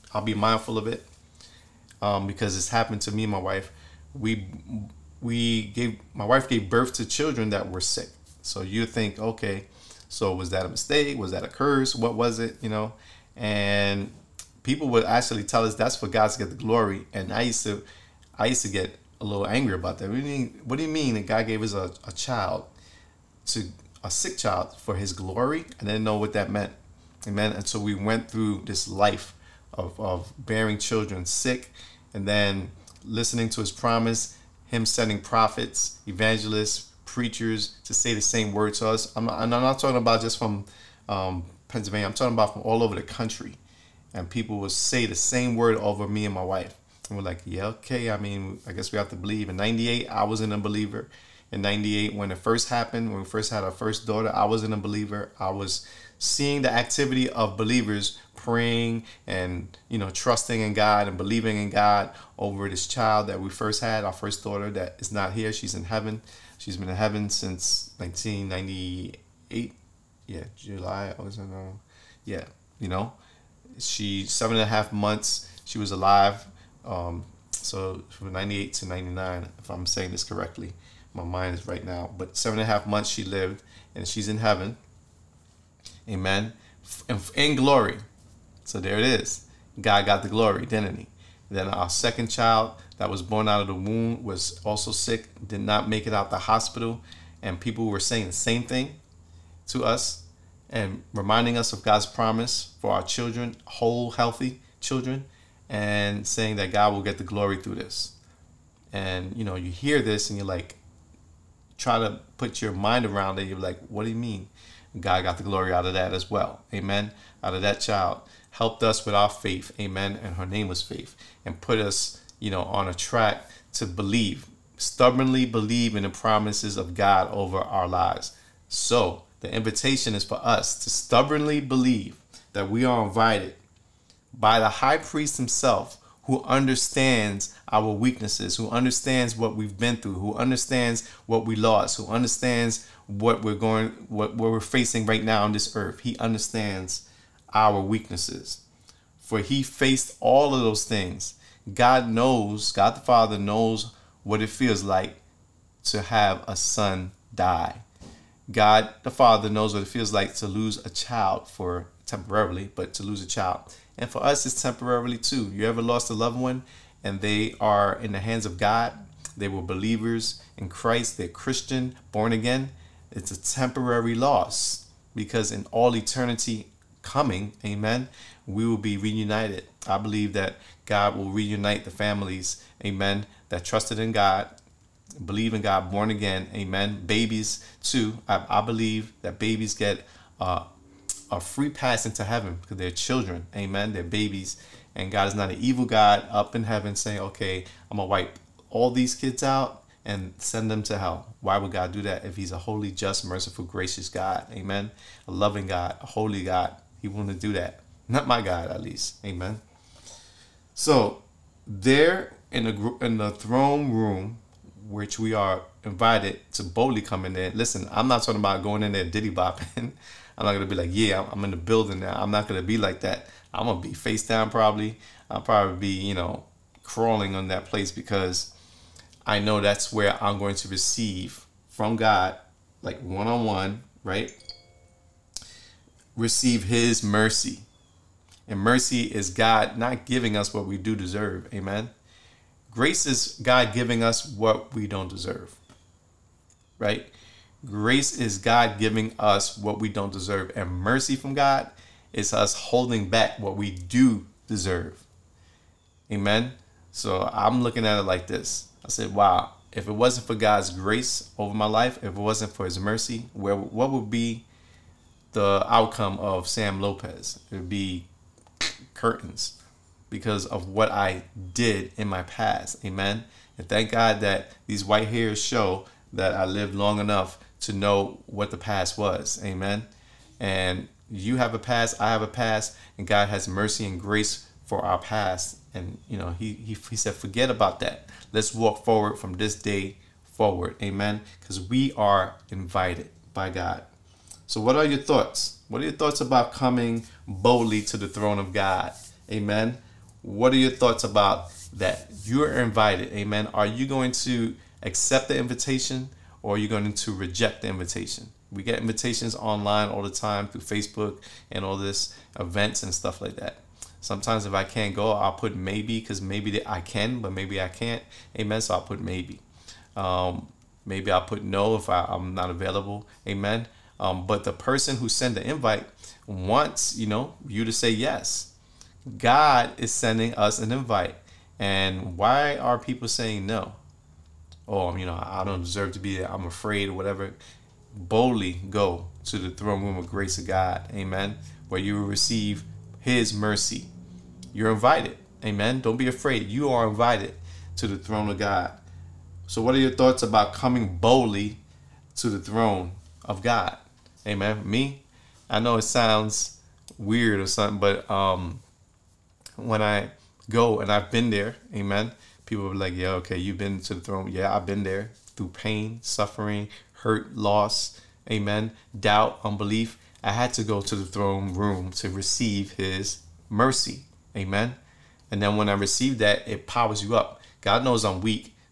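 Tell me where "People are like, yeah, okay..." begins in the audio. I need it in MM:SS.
06:02.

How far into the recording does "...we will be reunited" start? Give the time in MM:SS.
02:58.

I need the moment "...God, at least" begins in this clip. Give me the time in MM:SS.
03:28.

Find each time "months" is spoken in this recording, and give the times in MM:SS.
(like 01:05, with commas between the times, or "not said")
01:14, 01:22.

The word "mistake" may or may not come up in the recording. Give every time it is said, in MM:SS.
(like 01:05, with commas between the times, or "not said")
00:10.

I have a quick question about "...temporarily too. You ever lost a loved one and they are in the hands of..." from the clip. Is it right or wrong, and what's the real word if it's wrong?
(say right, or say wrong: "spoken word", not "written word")
right.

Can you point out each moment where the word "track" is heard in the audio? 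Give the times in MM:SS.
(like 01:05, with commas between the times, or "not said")
02:02.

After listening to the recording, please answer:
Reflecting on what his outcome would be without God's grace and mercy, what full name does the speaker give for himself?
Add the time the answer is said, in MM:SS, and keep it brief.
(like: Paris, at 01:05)
Sam Lopez, at 04:26.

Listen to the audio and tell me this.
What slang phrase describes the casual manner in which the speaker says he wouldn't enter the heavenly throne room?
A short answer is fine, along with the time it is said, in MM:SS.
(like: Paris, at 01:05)
diddy bopping, at 03:39.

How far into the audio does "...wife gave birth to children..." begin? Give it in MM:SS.
00:06.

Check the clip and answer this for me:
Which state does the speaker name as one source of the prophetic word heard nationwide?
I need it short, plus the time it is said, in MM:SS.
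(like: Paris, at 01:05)
Pennsylvania, at 00:41.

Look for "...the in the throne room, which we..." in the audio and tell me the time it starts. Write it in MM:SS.
03:32.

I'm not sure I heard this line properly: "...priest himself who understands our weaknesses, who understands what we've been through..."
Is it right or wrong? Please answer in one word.
right.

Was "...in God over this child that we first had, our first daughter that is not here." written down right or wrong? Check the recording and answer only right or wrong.
right.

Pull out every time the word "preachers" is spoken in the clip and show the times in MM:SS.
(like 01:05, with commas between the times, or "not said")
00:37.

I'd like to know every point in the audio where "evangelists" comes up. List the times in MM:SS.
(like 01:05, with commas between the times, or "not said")
00:36.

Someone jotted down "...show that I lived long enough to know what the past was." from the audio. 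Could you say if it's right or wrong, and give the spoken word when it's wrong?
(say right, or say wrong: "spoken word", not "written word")
right.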